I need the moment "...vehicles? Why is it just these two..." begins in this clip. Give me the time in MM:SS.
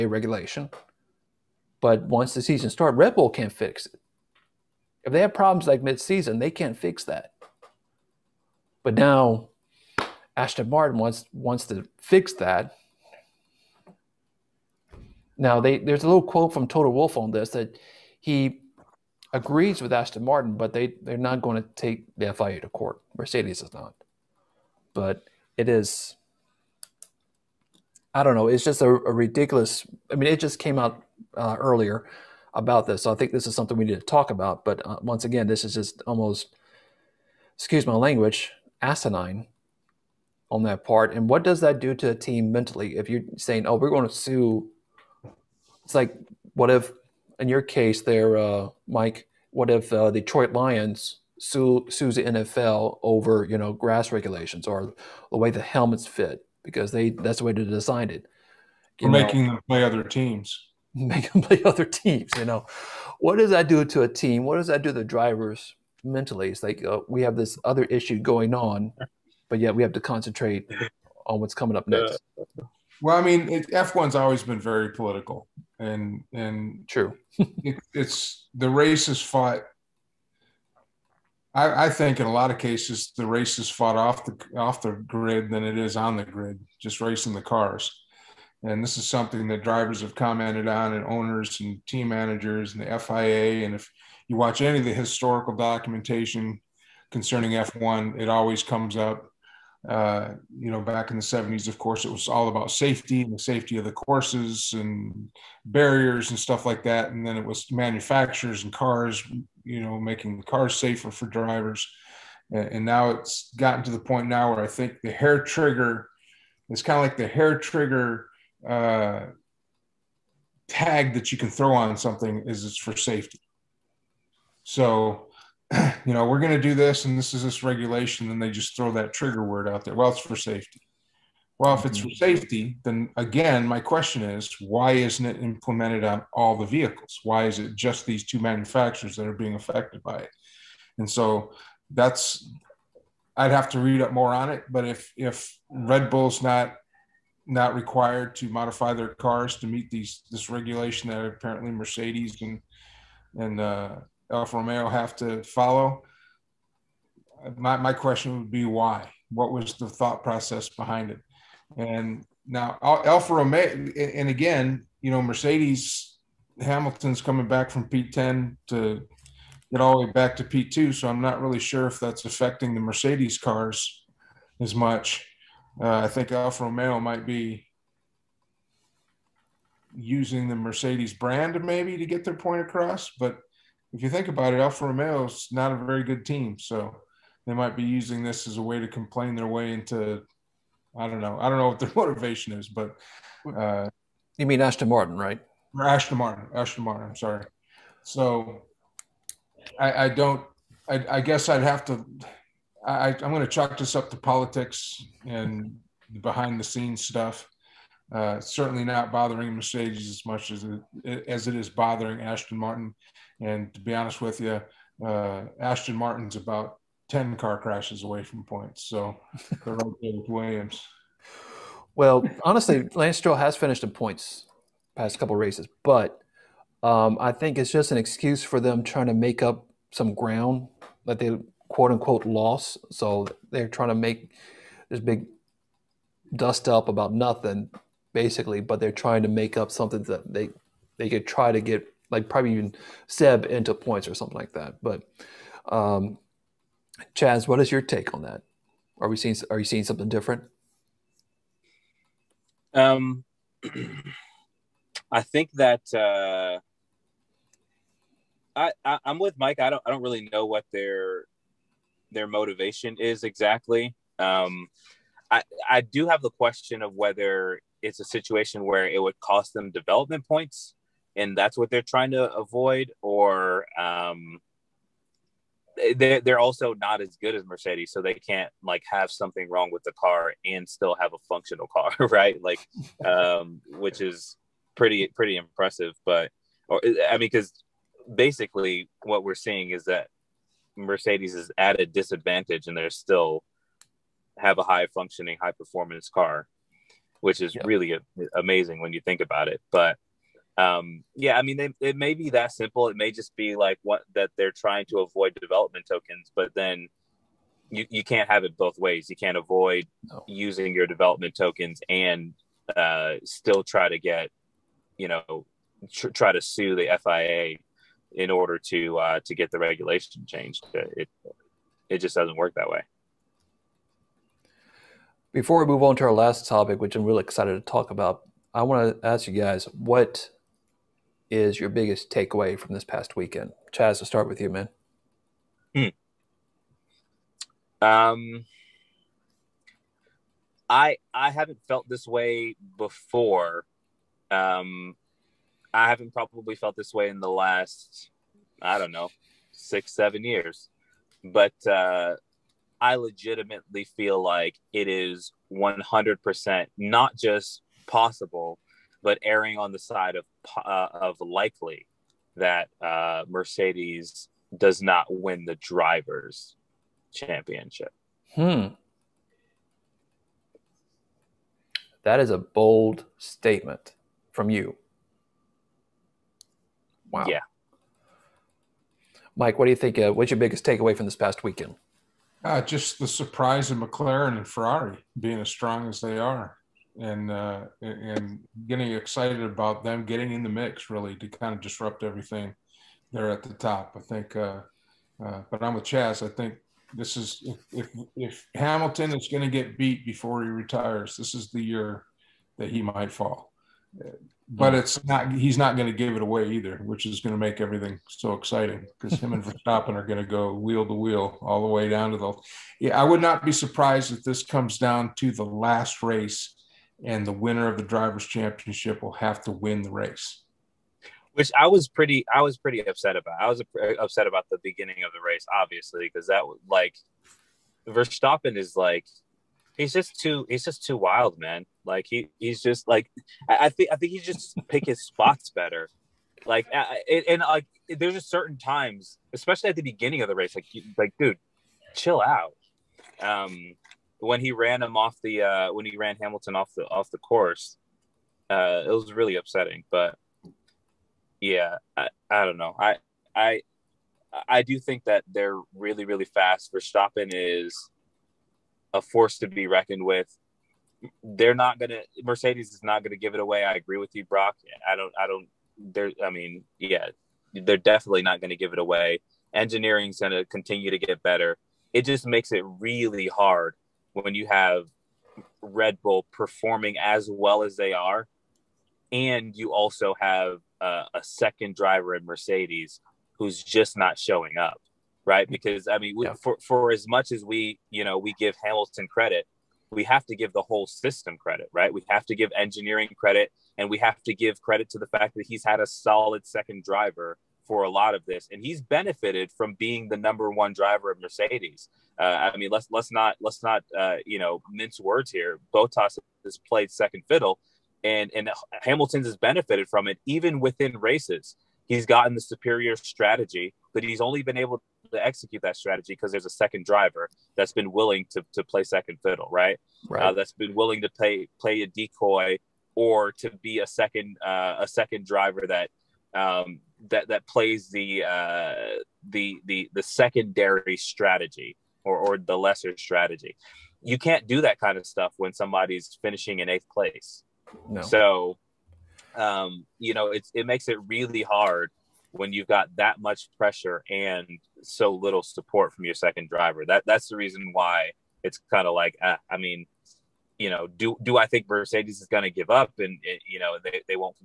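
02:16.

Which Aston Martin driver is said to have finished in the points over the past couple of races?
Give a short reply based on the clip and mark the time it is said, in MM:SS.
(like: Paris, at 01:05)
Lance Stroll, at 03:42.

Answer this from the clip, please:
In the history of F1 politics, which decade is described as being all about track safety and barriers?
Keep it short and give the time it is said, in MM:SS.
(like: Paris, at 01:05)
the 70s, at 01:41.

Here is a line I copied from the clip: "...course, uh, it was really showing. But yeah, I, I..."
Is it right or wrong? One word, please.
wrong.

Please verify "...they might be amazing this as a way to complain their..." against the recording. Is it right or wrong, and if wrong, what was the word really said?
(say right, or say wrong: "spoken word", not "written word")
wrong: "using", not "amazing".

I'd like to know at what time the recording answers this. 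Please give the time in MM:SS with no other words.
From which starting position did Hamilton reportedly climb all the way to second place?
02:47.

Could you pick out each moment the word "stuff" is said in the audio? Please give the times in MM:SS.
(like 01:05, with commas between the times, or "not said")
01:46, 03:27, 08:55.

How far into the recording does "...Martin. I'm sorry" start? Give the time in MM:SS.
03:16.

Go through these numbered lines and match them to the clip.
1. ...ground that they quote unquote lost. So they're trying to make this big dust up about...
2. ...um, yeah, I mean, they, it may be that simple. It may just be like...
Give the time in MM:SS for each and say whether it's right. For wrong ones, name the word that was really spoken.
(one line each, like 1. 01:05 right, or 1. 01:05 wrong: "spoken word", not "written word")
1. 03:50 right
2. 05:00 right.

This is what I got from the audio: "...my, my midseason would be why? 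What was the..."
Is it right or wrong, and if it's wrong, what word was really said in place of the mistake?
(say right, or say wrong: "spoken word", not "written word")
wrong: "question", not "midseason".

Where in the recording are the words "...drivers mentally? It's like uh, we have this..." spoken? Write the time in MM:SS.
01:05.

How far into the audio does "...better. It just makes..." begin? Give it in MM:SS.
07:51.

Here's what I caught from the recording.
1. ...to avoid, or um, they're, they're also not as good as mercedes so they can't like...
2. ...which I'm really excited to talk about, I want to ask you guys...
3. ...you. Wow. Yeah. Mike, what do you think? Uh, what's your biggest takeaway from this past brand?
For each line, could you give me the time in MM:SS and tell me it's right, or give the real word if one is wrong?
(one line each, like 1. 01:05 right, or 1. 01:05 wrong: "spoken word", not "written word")
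1. 04:32 right
2. 05:26 right
3. 06:14 wrong: "weekend", not "brand".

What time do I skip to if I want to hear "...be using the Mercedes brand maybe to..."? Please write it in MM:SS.
02:57.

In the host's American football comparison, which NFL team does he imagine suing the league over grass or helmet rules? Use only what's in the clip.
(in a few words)
Detroit Lions.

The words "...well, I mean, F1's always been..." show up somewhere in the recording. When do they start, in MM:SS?
01:12.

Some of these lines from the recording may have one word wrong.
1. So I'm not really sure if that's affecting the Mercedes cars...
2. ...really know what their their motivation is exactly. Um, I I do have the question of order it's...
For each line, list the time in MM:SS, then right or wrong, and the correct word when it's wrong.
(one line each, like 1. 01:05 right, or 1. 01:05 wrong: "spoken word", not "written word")
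1. 02:50 right
2. 04:20 wrong: "whether", not "order".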